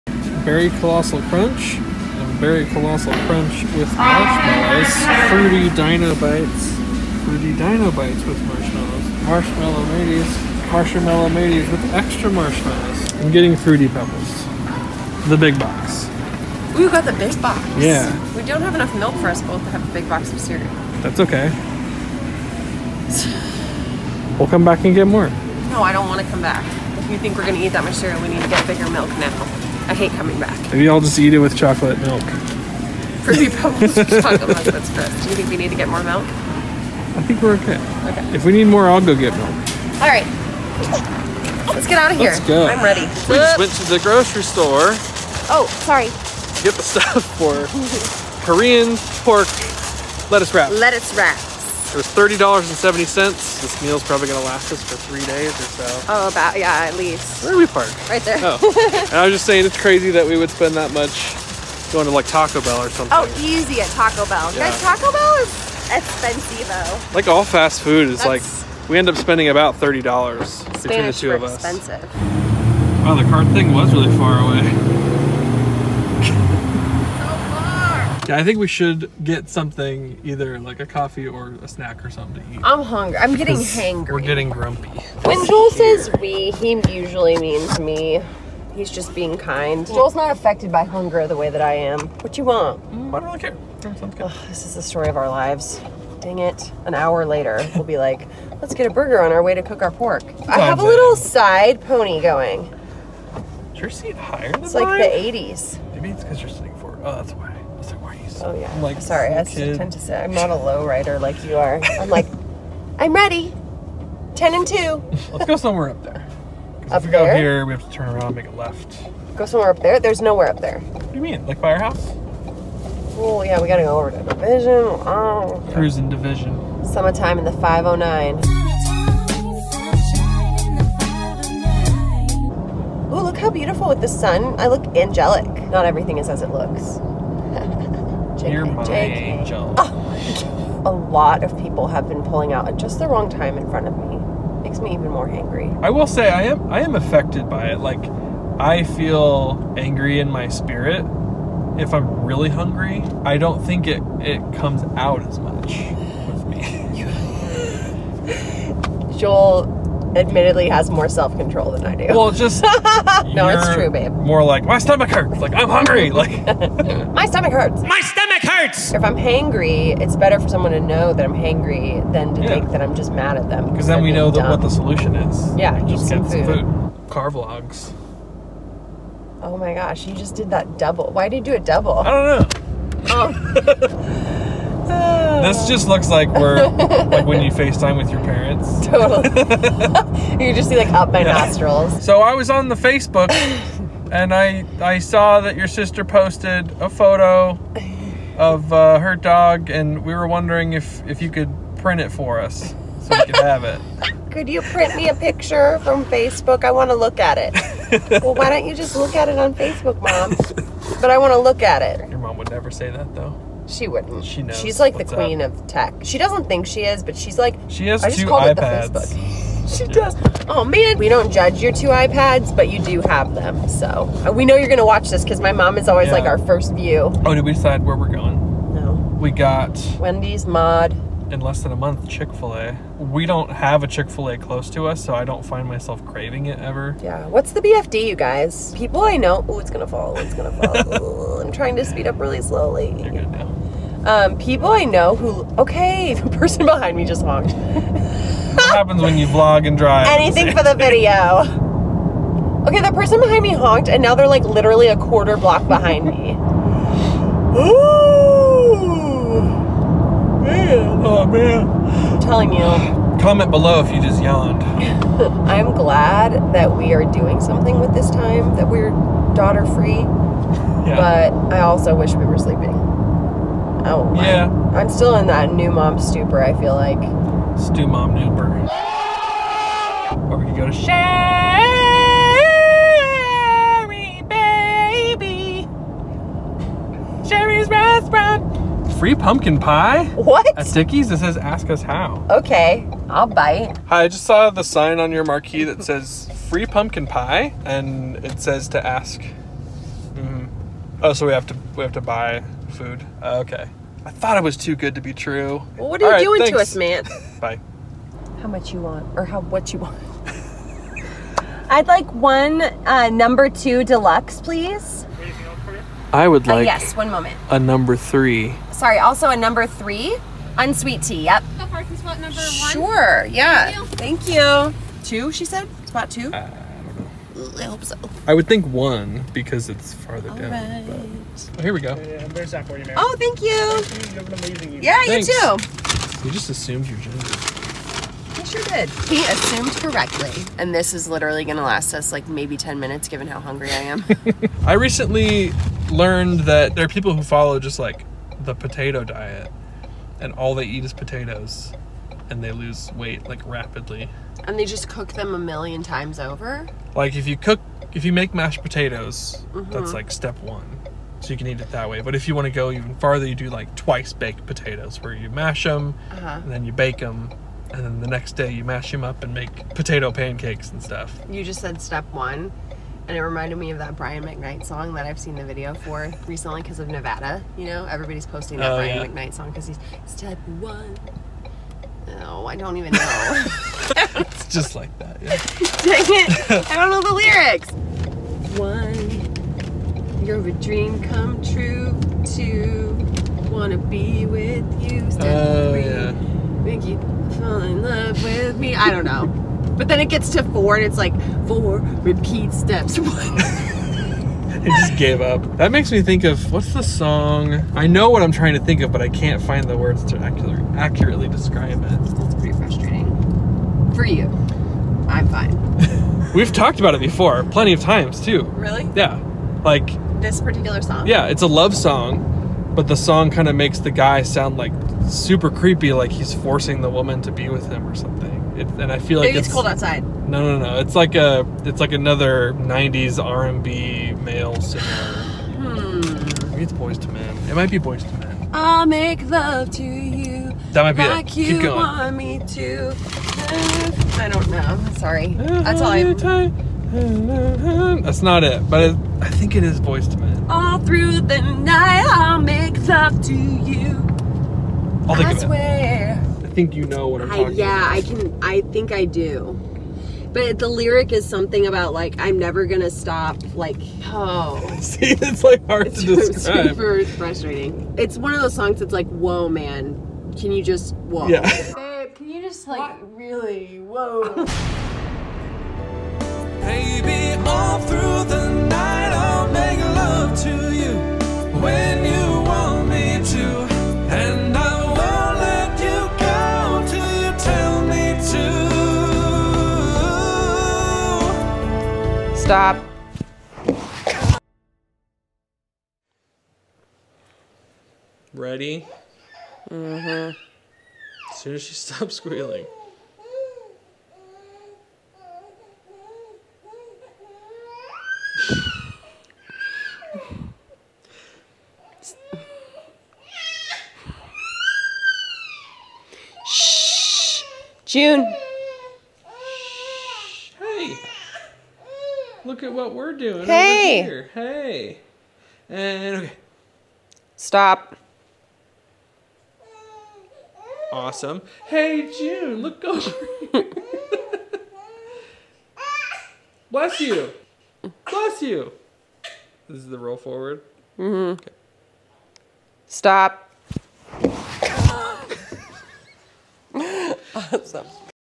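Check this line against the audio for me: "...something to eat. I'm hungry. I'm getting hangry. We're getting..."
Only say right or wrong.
right.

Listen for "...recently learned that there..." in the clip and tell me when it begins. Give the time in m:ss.
5:44.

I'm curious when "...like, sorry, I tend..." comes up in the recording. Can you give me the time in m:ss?
1:48.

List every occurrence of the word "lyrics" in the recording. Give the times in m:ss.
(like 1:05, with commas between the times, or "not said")
6:27, 7:40.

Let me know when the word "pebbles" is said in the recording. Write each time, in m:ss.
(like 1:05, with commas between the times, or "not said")
0:13, 0:33.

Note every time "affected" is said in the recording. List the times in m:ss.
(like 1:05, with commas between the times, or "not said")
1:30, 2:26.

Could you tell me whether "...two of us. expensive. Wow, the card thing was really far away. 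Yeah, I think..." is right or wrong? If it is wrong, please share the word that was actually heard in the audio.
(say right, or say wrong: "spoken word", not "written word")
right.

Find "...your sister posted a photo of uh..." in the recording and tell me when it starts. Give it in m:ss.
3:15.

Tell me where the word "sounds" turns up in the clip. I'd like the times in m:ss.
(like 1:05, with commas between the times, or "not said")
1:33, 7:04.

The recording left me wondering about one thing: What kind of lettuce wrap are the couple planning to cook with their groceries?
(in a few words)
Korean pork.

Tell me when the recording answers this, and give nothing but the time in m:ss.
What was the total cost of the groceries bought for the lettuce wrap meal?
0:52.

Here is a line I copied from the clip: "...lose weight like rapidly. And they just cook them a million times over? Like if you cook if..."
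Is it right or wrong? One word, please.
right.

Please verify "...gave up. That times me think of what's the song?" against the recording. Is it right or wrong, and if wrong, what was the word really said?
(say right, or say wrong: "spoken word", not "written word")
wrong: "makes", not "times".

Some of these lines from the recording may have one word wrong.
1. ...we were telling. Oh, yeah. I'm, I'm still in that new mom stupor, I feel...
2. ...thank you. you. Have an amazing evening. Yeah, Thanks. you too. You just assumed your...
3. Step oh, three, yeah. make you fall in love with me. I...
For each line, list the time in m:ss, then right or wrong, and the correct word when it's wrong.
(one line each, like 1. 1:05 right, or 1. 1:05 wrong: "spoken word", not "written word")
1. 4:32 wrong: "sleeping", not "telling"
2. 5:33 right
3. 6:35 right.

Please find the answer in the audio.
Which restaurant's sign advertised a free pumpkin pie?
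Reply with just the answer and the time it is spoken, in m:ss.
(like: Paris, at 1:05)
Dickie's, at 4:50.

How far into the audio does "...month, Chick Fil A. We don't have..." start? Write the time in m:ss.
3:51.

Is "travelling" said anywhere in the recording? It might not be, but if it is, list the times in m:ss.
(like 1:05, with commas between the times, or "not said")
not said.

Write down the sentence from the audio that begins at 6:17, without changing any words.
You know, everybody's posting that oh, Brian yeah.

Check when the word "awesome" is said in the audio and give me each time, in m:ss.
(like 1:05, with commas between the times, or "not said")
8:50, 9:07.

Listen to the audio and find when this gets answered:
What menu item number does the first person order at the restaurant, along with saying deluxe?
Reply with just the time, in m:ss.
5:13.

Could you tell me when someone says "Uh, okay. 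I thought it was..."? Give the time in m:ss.
5:03.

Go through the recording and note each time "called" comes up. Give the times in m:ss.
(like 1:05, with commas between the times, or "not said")
3:38.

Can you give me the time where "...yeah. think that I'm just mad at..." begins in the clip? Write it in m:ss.
2:52.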